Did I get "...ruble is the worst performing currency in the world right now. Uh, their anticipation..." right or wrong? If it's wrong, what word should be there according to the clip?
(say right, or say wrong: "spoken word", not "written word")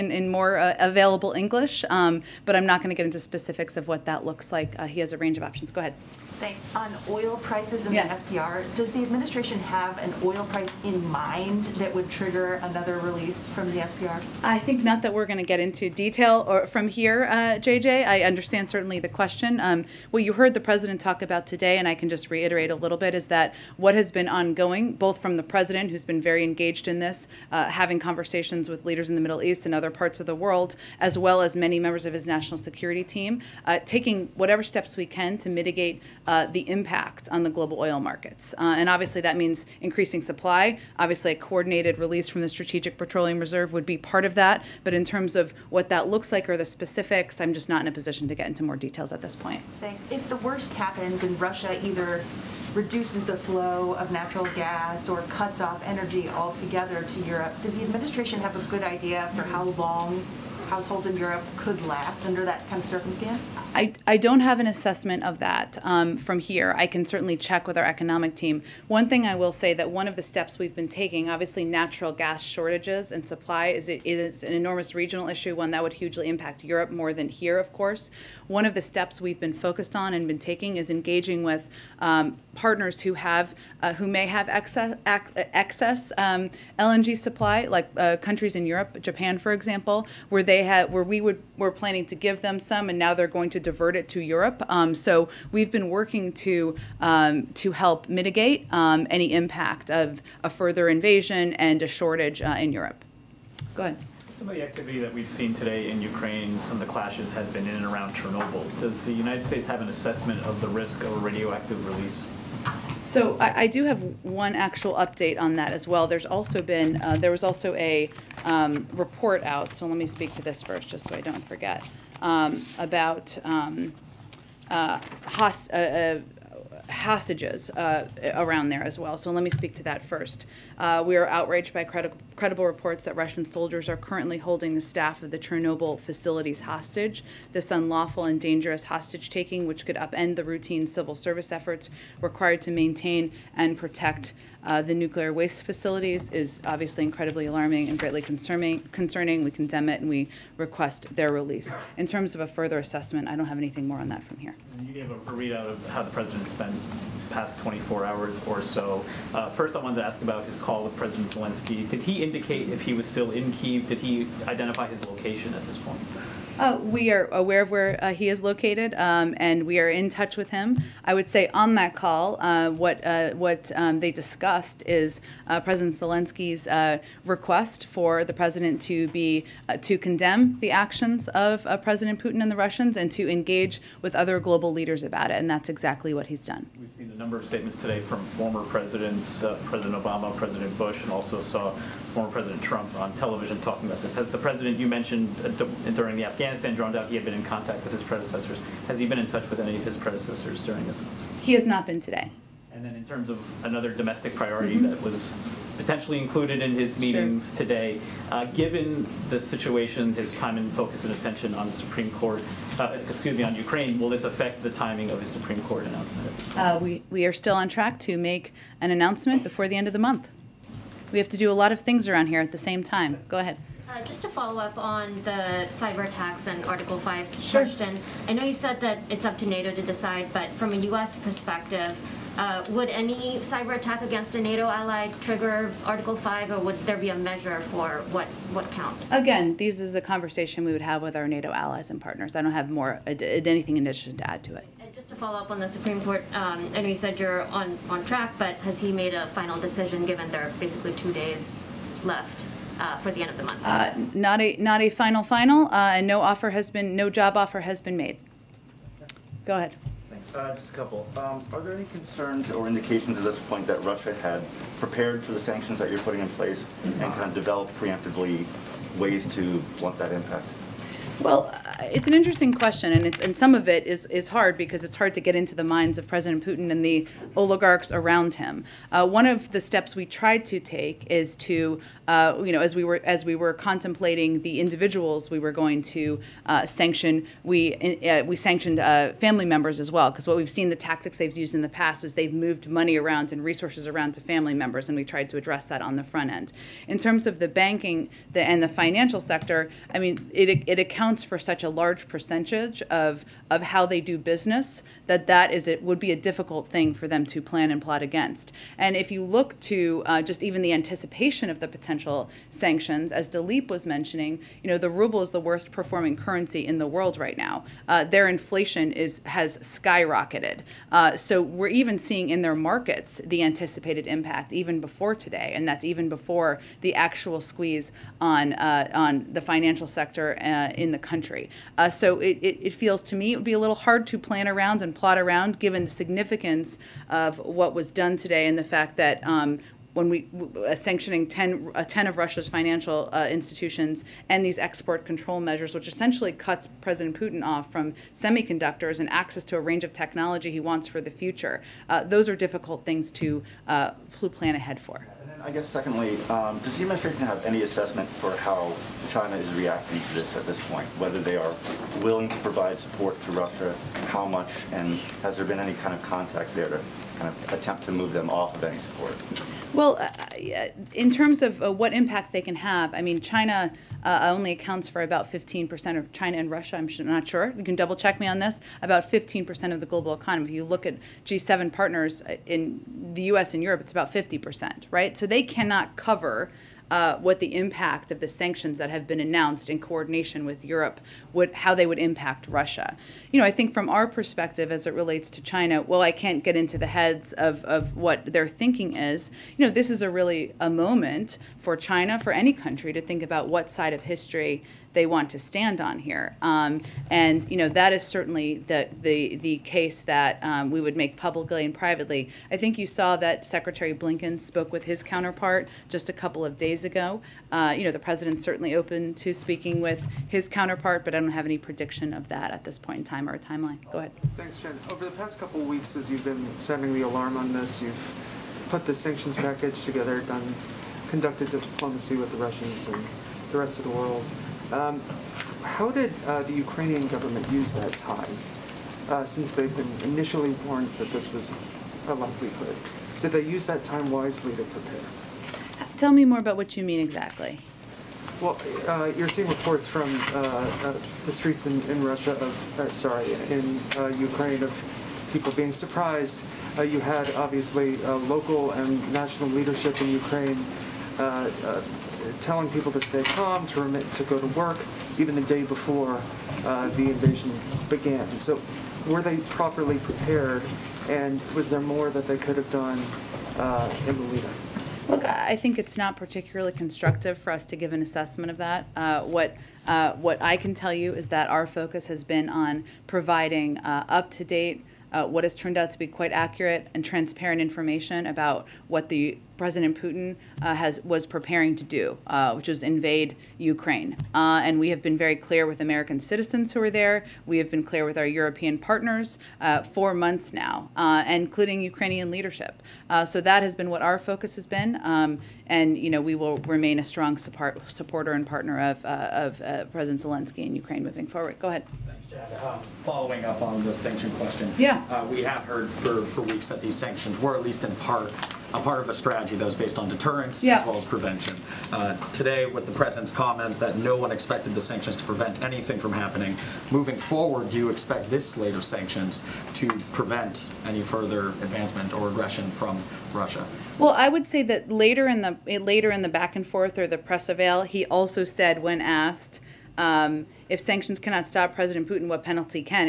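wrong: "inflation", not "anticipation".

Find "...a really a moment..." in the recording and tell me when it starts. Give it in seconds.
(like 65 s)
400 s.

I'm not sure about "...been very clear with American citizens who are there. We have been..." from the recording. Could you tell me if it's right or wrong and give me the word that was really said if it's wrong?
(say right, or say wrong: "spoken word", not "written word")
right.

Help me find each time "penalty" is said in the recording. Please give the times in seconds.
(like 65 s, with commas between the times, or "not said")
542 s.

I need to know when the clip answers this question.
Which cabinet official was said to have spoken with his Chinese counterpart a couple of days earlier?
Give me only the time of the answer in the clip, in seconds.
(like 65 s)
413 s.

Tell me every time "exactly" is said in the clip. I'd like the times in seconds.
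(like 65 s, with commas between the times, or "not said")
185 s, 447 s.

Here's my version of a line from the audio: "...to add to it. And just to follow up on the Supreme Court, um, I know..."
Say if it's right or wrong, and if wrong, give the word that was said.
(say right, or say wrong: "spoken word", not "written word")
right.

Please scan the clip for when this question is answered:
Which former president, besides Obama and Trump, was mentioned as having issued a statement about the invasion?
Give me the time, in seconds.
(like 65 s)
190 s.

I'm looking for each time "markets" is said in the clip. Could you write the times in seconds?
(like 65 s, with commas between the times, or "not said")
37 s, 322 s.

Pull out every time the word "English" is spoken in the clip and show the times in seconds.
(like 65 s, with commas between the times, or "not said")
1 s.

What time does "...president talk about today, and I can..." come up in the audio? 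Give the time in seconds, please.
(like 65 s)
20 s.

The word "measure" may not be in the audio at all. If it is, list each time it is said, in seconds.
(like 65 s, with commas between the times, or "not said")
237 s, 345 s.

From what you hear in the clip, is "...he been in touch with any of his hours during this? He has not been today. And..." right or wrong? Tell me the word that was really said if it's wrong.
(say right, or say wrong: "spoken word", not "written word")
wrong: "predecessors", not "hours".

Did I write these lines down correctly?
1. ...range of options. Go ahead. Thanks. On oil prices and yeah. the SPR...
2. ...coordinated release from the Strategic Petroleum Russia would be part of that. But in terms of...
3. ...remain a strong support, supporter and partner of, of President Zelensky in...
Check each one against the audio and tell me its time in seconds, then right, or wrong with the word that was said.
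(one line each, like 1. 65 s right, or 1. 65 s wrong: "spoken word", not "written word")
1. 5 s right
2. 41 s wrong: "Reserve", not "Russia"
3. 506 s right.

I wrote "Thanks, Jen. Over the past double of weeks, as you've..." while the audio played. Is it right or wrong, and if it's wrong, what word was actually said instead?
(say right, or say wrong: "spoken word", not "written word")
wrong: "couple", not "double".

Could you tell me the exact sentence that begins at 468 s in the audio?
So were they properly prepared, and was there more that they could have done uh, in Lolita?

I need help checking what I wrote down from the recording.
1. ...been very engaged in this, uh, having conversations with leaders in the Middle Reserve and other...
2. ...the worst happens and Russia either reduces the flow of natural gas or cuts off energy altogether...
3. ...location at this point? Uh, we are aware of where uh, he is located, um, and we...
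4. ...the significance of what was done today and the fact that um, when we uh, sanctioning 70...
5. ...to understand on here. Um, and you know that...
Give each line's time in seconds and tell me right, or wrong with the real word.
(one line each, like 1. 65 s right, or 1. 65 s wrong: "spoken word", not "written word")
1. 26 s wrong: "East", not "Reserve"
2. 50 s right
3. 165 s right
4. 335 s wrong: "10", not "70"
5. 405 s wrong: "stand", not "understand".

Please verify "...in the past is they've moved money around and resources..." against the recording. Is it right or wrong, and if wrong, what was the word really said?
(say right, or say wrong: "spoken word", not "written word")
right.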